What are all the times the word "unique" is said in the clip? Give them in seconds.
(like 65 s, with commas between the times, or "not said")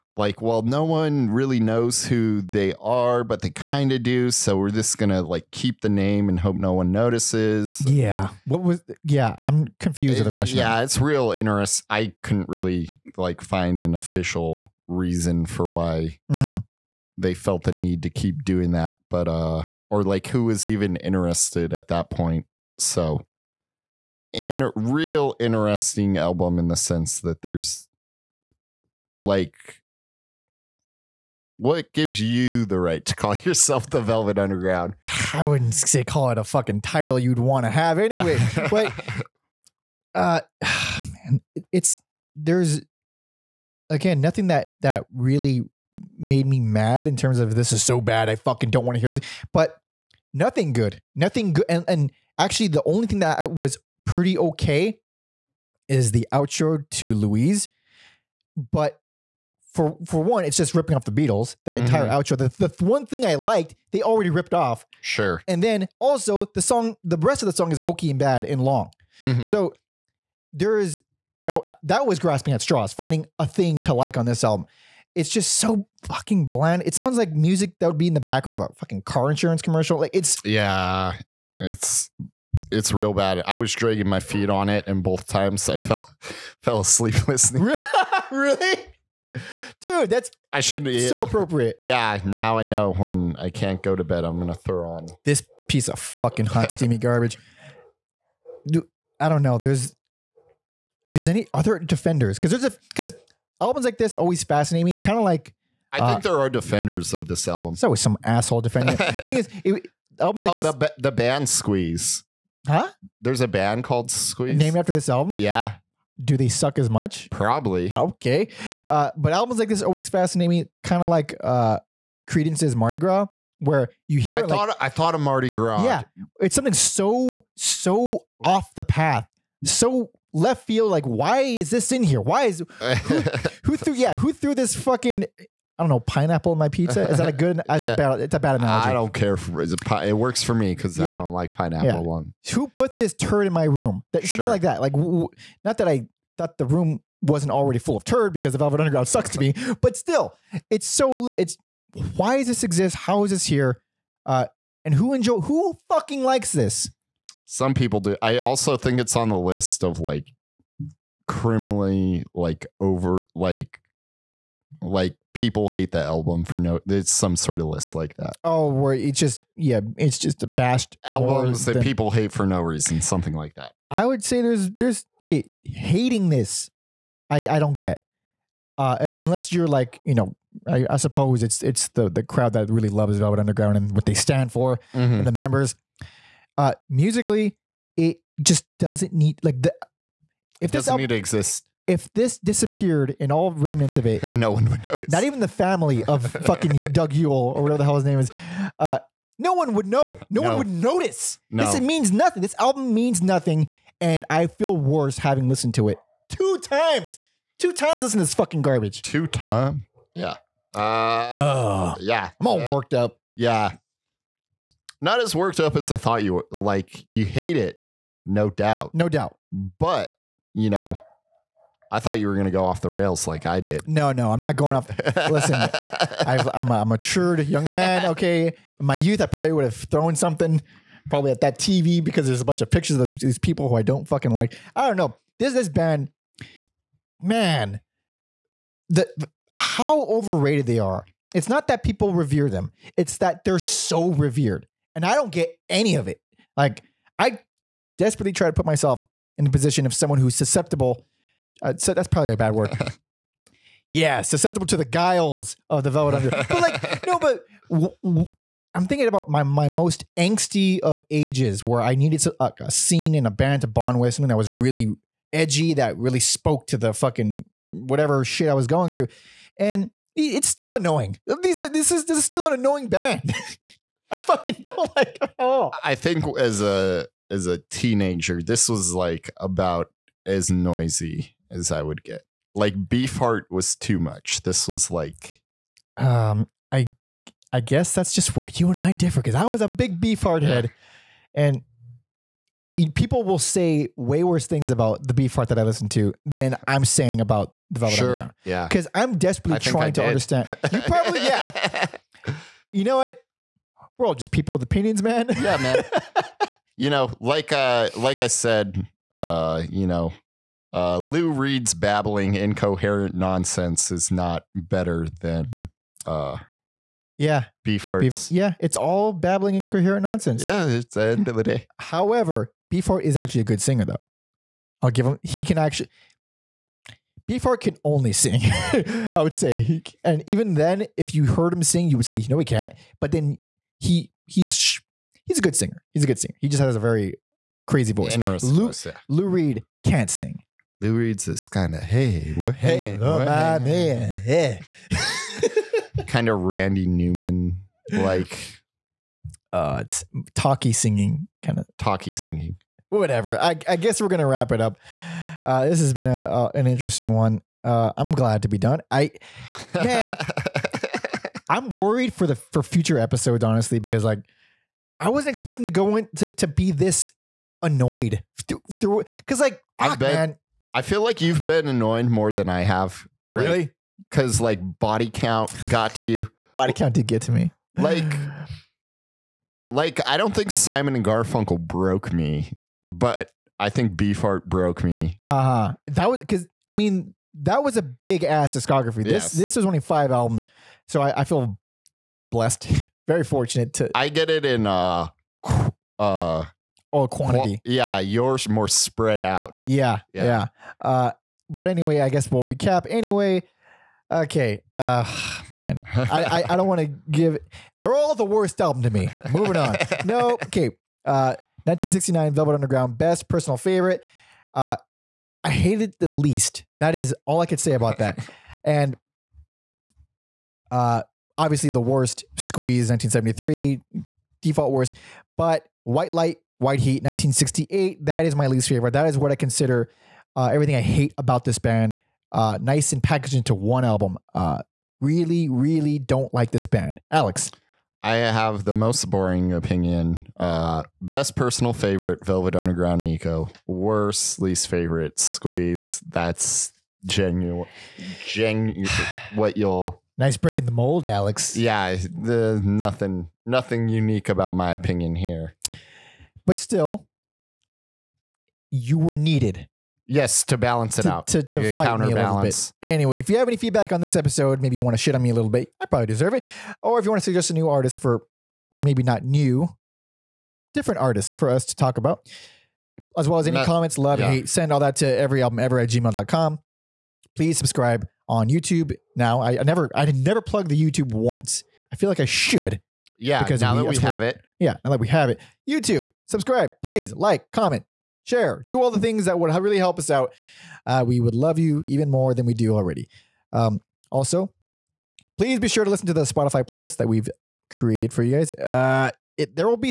453 s.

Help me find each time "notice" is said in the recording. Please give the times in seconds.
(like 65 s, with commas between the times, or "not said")
6 s, 194 s, 200 s.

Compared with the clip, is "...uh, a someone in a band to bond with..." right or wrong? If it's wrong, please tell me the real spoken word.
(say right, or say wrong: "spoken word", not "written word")
wrong: "scene", not "someone".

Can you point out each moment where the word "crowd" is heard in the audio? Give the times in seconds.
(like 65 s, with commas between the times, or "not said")
182 s.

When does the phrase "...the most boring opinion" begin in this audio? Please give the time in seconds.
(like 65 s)
438 s.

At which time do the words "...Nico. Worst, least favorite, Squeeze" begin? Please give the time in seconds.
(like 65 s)
443 s.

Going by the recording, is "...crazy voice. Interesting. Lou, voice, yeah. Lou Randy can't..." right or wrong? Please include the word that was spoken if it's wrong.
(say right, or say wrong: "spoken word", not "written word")
wrong: "Reed", not "Randy".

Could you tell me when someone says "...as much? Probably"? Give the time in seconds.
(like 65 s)
116 s.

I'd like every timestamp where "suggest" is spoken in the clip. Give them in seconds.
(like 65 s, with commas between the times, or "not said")
467 s.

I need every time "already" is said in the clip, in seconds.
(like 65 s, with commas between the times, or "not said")
64 s, 147 s, 492 s.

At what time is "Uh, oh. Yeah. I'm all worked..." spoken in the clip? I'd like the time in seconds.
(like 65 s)
210 s.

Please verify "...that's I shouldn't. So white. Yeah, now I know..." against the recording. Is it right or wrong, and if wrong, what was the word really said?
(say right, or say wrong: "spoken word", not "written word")
wrong: "appropriate", not "white".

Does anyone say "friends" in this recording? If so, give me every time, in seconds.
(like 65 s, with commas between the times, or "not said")
not said.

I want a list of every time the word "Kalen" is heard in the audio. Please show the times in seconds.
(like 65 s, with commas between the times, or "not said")
not said.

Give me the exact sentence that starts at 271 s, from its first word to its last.
These are, this is this is still an annoying band.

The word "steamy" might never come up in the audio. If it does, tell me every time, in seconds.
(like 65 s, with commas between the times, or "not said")
96 s.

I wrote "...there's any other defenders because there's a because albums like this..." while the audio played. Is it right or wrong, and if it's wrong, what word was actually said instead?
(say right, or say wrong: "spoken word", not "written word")
right.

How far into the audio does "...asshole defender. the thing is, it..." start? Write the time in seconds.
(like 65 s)
108 s.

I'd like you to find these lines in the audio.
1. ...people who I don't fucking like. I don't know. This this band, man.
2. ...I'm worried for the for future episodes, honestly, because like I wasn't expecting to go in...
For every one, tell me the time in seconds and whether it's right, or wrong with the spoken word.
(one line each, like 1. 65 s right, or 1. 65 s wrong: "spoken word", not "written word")
1. 233 s right
2. 361 s right.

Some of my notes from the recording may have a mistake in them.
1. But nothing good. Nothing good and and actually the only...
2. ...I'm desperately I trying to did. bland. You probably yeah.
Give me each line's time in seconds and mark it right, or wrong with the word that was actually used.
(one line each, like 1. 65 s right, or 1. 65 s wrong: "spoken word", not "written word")
1. 49 s right
2. 298 s wrong: "understand", not "bland".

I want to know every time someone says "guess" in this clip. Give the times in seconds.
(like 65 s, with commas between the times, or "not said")
287 s, 353 s, 402 s.